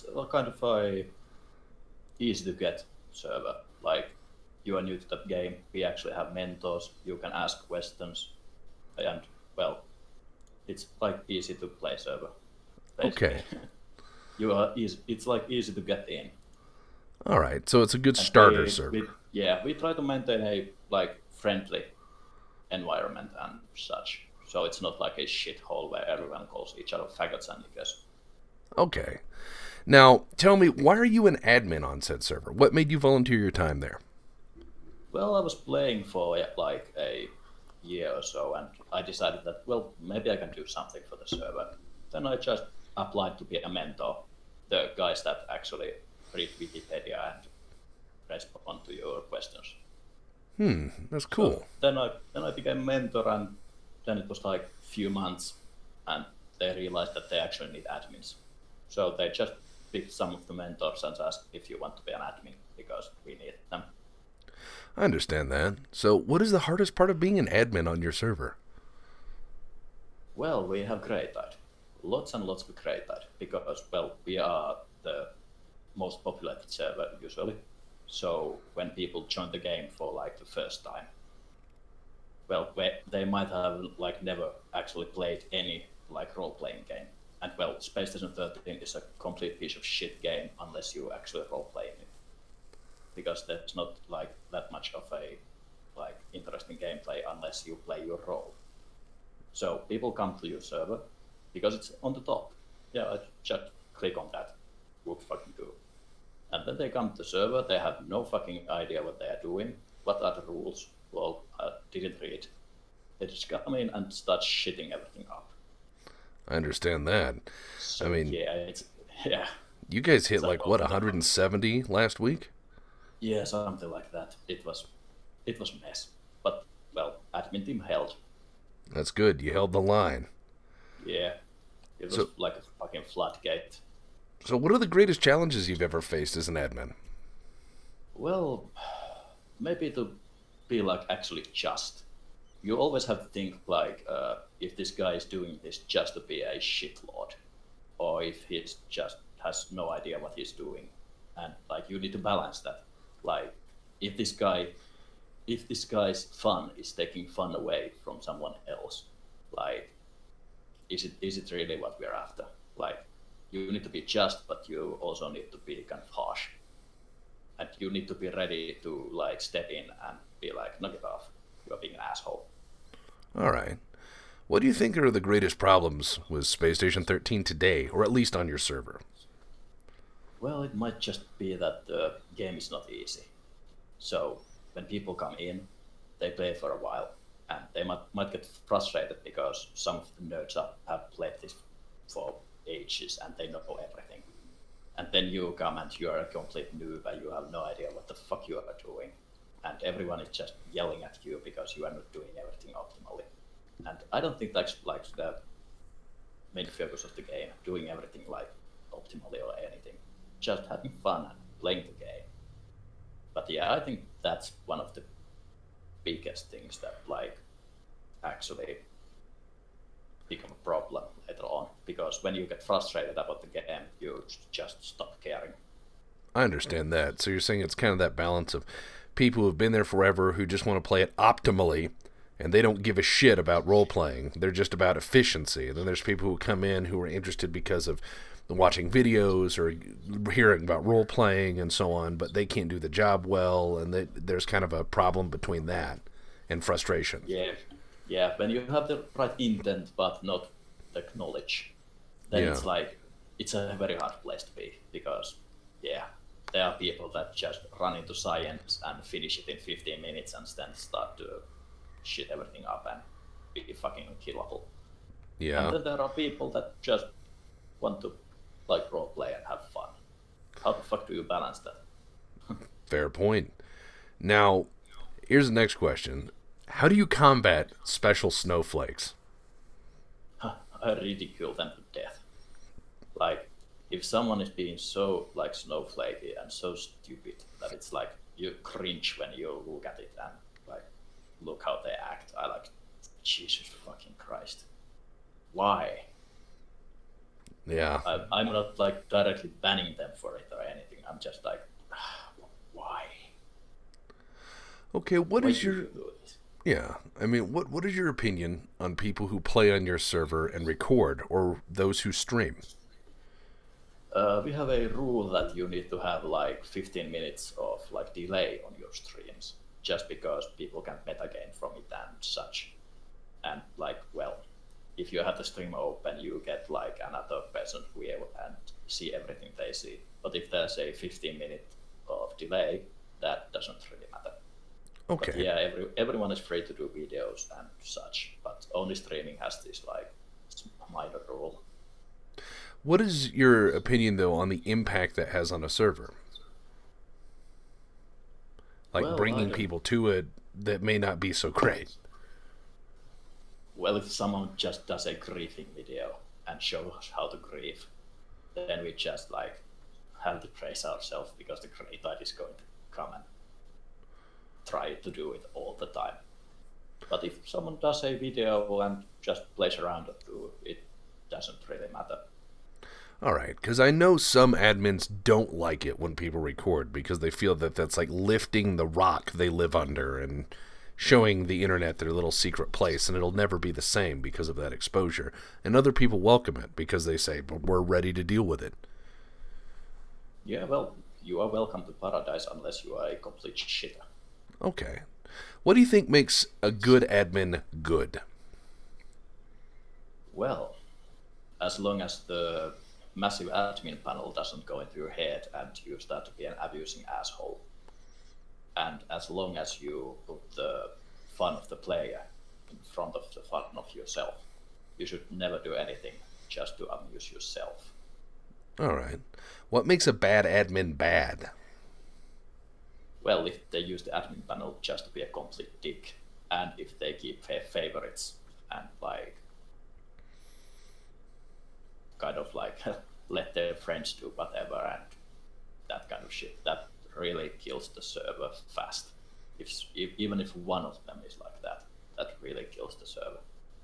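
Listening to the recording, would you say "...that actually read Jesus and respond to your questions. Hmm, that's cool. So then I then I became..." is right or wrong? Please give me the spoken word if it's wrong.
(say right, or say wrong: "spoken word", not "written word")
wrong: "Wikipedia", not "Jesus".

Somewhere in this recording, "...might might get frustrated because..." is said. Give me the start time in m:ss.
3:07.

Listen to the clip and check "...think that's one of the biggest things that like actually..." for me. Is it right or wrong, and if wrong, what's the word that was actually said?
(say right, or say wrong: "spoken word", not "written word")
right.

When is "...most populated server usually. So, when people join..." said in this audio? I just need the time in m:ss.
1:15.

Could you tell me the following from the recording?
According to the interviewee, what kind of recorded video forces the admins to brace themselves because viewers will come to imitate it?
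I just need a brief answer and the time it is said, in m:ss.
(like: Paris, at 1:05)
griefing video, at 5:55.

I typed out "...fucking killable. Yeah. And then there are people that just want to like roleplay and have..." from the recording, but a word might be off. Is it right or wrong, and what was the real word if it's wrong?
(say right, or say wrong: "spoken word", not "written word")
right.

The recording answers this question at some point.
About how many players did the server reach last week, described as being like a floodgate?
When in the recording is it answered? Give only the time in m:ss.
2:00.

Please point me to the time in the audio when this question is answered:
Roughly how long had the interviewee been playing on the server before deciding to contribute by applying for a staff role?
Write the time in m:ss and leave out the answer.
0:36.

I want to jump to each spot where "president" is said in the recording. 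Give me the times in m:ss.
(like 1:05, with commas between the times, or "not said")
not said.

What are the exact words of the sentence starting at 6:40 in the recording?
Well, as long as the massive admin panel doesn't go into your head and you start to be an abusing asshole.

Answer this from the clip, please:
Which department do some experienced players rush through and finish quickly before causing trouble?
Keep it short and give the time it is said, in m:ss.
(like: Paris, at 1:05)
science, at 4:18.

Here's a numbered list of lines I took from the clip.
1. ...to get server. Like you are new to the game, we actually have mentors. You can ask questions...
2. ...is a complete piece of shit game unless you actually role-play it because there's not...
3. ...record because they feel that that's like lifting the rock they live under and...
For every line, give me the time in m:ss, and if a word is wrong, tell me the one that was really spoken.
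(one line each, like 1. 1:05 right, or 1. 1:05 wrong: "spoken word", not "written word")
1. 0:02 right
2. 1:28 right
3. 6:16 right.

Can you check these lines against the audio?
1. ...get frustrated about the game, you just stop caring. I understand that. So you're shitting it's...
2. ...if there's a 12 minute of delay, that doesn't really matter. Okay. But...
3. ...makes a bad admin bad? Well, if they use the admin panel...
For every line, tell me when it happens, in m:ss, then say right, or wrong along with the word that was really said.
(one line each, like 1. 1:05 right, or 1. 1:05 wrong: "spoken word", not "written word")
1. 3:42 wrong: "saying", not "shitting"
2. 5:30 wrong: "15", not "12"
3. 6:59 right.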